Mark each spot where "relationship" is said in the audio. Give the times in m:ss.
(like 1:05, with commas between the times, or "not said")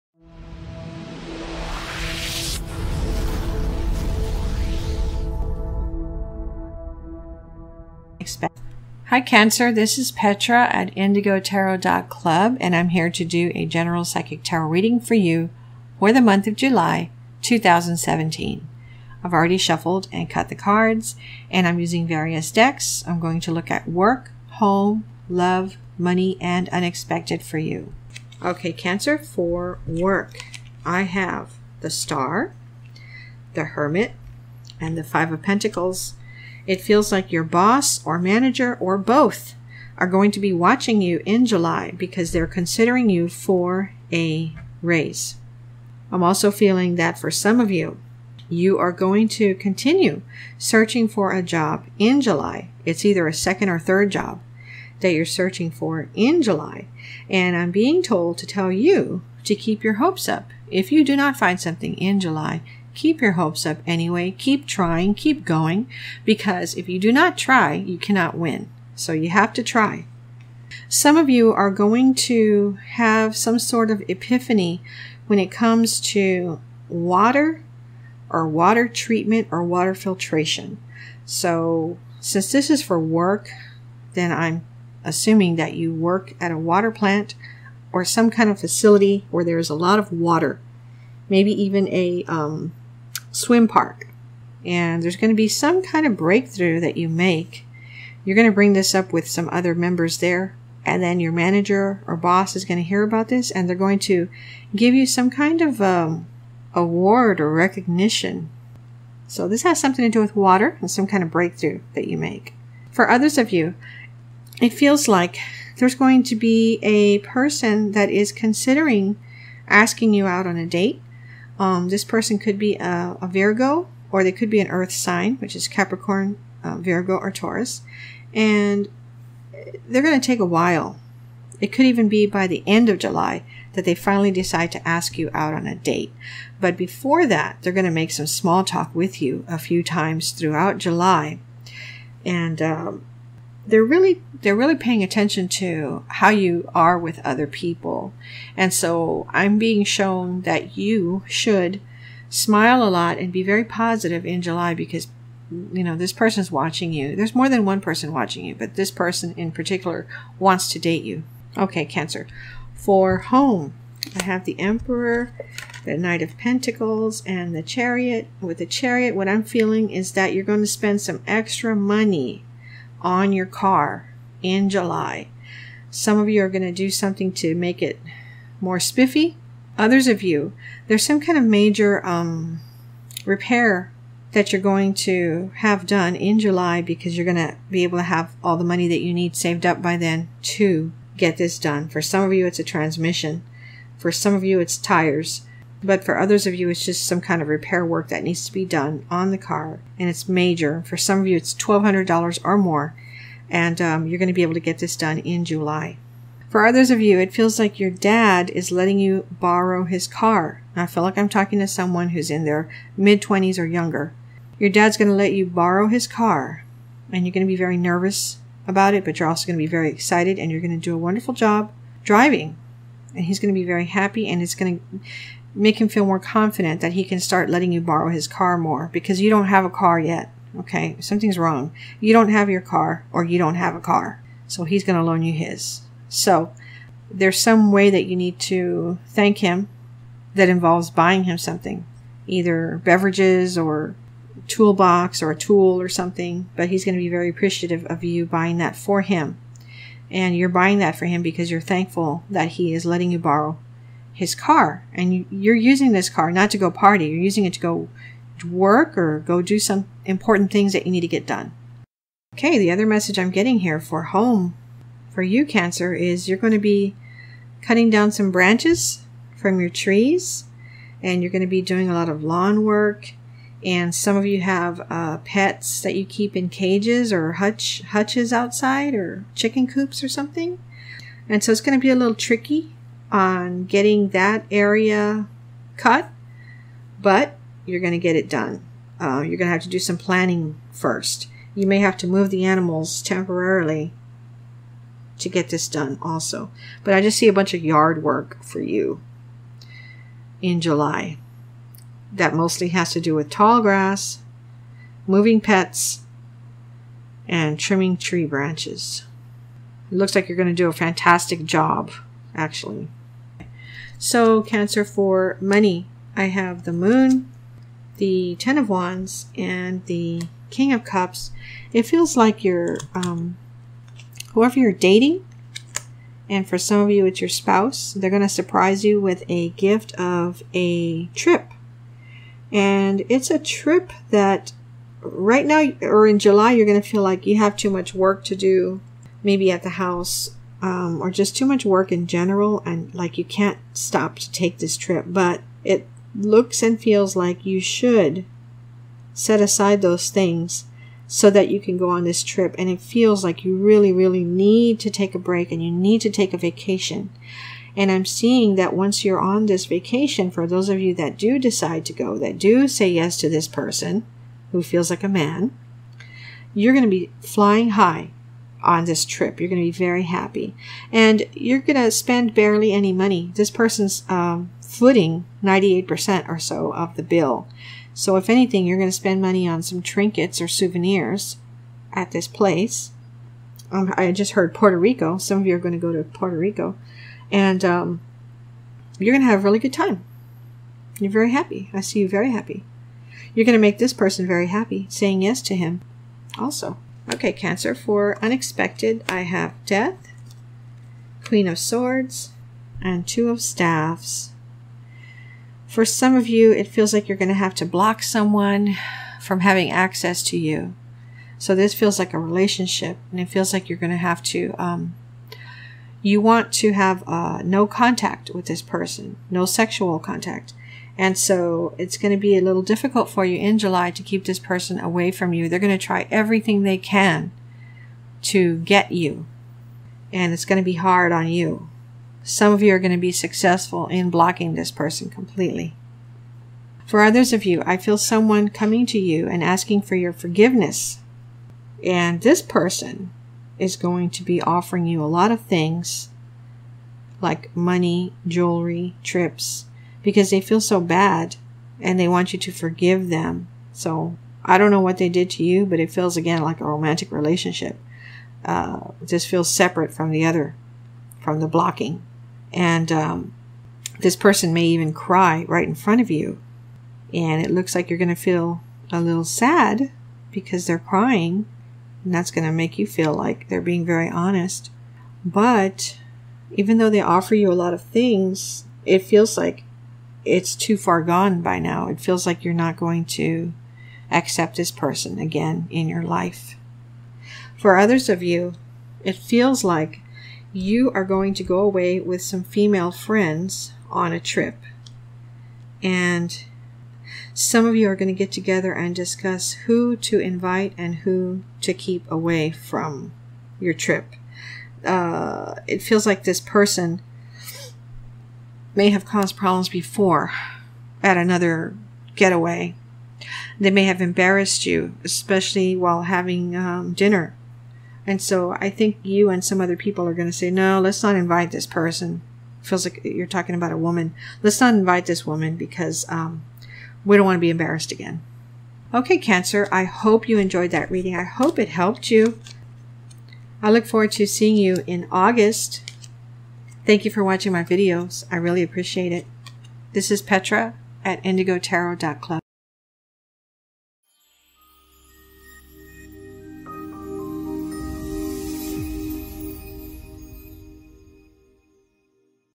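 6:52, 7:37.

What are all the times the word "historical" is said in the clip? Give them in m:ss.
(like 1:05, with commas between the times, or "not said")
not said.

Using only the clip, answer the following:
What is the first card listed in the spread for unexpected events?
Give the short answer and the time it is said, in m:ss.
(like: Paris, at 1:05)
Death, at 6:39.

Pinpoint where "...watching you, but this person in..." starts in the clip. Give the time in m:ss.
2:38.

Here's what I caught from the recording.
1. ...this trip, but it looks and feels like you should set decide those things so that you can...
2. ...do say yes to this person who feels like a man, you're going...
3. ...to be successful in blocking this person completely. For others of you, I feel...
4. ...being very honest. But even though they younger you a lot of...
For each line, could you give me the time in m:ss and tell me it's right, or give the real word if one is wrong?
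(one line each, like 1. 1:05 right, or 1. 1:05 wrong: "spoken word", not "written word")
1. 5:44 wrong: "aside", not "decide"
2. 6:02 right
3. 7:12 right
4. 7:53 wrong: "offer", not "younger".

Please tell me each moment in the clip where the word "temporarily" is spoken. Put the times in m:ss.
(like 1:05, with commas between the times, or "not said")
4:53.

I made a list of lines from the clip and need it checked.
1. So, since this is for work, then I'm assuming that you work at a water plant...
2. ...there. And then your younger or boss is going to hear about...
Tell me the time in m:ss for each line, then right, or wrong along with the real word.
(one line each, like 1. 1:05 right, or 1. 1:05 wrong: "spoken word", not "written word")
1. 1:21 right
2. 1:40 wrong: "manager", not "younger".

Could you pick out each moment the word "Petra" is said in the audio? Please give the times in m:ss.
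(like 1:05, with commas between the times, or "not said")
0:10, 9:00.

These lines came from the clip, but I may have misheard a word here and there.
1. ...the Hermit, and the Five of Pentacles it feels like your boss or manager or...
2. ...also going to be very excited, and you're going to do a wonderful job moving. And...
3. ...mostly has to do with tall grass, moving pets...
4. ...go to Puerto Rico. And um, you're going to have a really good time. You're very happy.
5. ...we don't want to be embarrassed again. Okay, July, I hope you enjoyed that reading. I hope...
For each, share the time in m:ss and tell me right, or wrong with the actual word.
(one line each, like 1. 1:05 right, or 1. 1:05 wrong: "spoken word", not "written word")
1. 0:33 right
2. 3:39 wrong: "driving", not "moving"
3. 5:02 right
4. 6:25 right
5. 8:47 wrong: "Cancer", not "July".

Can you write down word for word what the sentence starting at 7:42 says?
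And um, this person may even cry right in front of you.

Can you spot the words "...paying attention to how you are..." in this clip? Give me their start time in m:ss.
2:24.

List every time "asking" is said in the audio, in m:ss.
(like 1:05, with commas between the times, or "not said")
1:59, 7:19.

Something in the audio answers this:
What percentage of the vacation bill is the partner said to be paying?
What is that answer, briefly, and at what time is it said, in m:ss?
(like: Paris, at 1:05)
98%, at 6:15.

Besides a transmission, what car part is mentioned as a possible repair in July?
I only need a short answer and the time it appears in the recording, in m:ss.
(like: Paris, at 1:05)
Tires, at 3:14.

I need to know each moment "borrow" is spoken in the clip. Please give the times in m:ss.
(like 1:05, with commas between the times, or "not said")
3:29, 3:35, 3:47, 4:13.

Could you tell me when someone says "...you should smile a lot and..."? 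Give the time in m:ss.
2:30.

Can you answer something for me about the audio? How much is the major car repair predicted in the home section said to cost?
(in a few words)
$1,200 or more.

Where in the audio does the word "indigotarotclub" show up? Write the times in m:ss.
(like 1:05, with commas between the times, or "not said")
0:10, 9:01.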